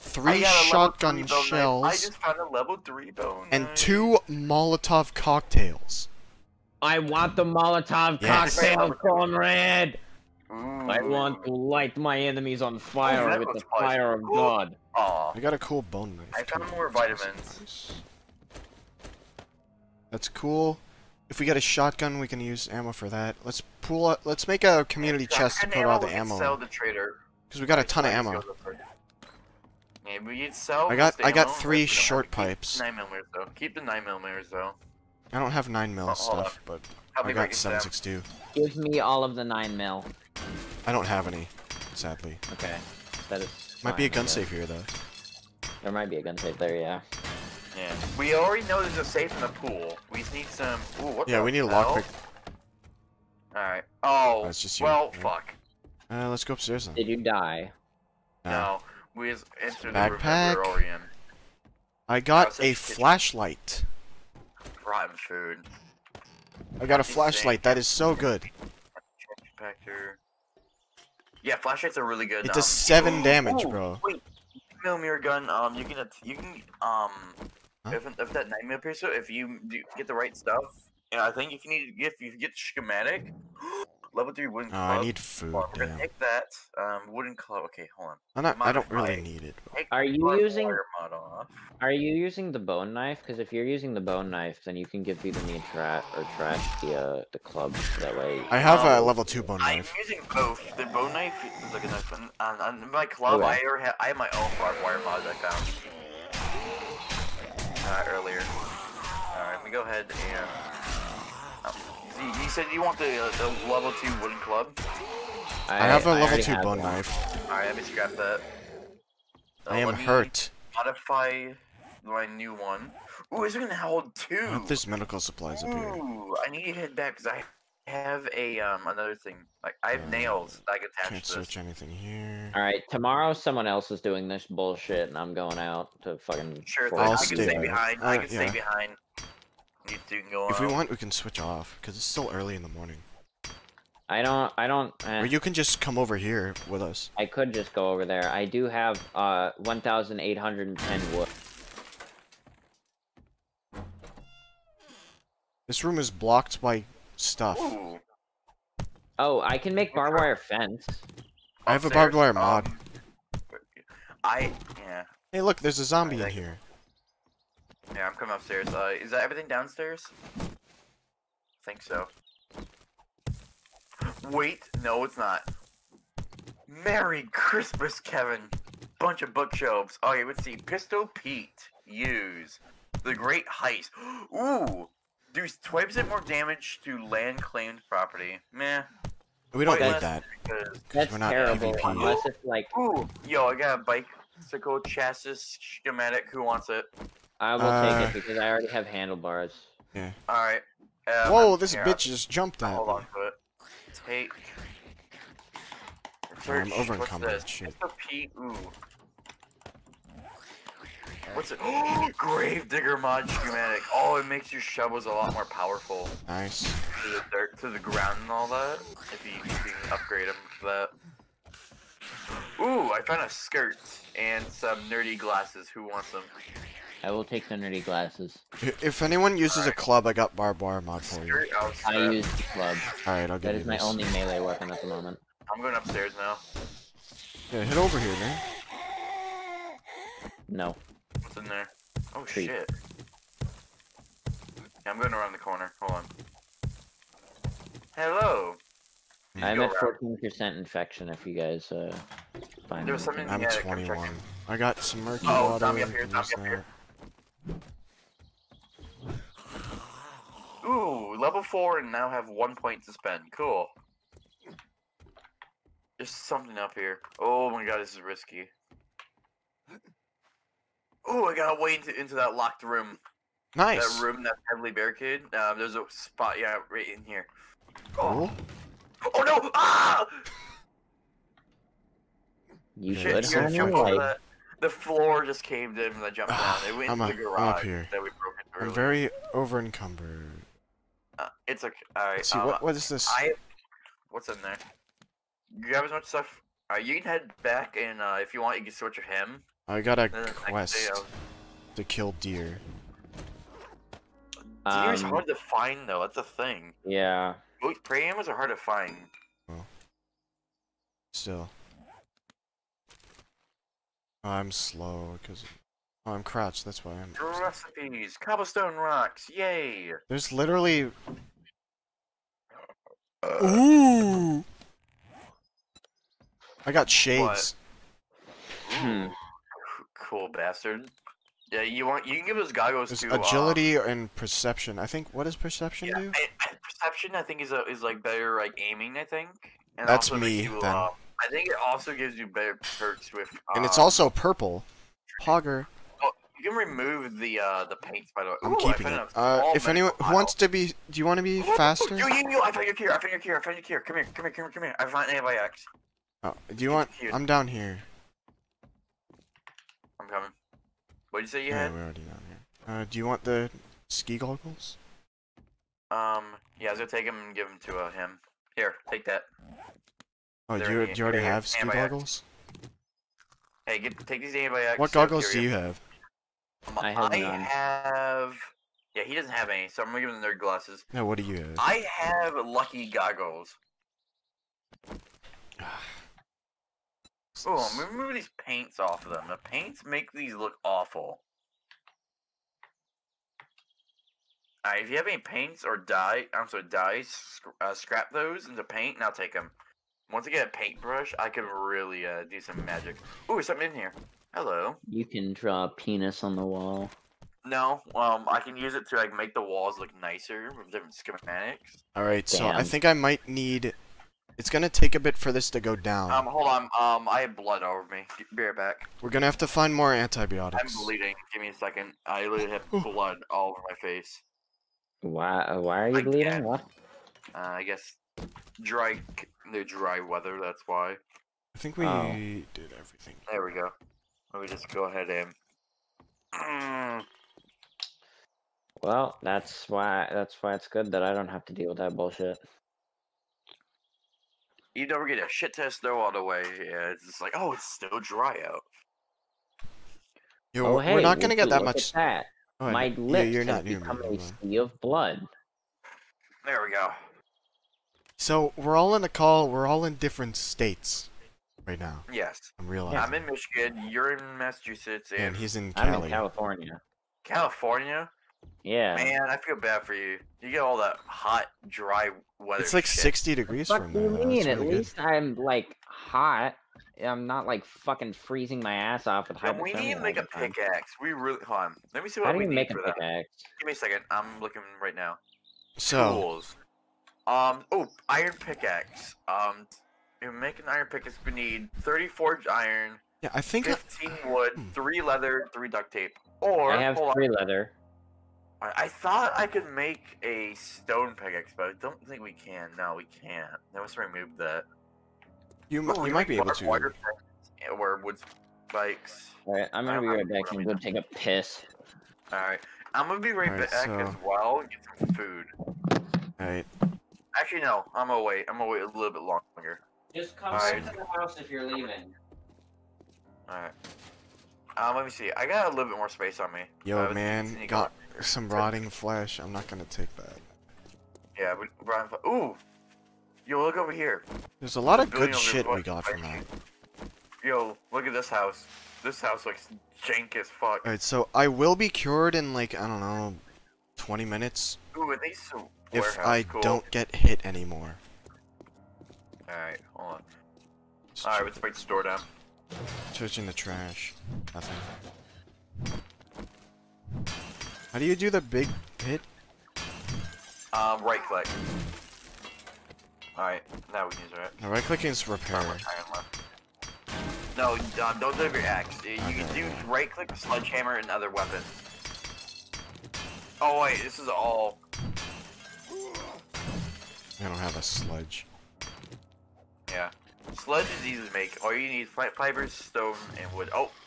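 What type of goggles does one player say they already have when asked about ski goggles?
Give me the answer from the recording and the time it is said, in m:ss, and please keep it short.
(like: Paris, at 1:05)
Lucky goggles, at 6:22.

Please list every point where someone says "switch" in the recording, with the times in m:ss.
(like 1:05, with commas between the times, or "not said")
2:21, 4:58.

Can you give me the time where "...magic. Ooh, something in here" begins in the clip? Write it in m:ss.
6:42.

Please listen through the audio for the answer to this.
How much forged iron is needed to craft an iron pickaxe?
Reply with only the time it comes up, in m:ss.
8:11.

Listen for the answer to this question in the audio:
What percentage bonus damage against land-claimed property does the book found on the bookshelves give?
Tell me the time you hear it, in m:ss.
3:05.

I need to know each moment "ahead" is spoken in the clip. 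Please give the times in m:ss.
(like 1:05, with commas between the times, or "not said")
1:49, 7:14.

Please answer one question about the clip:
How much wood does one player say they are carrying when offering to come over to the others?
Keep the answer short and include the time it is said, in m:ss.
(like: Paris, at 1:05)
1,810, at 2:29.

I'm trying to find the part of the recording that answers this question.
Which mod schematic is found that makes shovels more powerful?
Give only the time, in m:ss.
3:32.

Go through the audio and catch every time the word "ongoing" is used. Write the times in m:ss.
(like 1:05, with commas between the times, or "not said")
not said.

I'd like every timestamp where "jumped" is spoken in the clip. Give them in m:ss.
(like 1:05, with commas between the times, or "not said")
3:22, 4:46.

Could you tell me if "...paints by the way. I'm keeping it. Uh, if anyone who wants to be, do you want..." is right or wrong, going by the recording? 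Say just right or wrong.
right.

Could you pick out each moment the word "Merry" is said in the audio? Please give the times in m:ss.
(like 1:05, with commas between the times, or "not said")
2:56.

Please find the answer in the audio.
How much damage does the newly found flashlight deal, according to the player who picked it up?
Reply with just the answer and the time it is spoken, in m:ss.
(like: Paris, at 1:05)
7, at 1:12.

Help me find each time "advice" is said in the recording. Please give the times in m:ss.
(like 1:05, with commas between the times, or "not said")
not said.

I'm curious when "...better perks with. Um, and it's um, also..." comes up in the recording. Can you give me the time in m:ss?
5:42.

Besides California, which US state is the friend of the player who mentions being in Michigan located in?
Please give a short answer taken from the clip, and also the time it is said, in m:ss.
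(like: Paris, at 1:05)
Massachusetts, at 7:44.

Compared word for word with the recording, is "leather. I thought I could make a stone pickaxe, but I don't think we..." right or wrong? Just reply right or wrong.
right.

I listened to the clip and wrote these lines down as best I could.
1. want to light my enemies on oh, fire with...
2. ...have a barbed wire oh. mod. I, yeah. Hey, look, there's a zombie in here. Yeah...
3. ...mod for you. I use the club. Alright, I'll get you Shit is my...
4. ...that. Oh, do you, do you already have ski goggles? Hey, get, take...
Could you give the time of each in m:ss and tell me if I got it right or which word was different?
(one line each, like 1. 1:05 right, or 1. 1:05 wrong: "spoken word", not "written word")
1. 0:11 right
2. 2:41 right
3. 3:50 wrong: "That", not "Shit"
4. 6:09 right.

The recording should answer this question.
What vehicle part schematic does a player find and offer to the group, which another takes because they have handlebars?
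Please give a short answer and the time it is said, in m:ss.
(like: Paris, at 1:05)
Bicycle chassis, at 3:14.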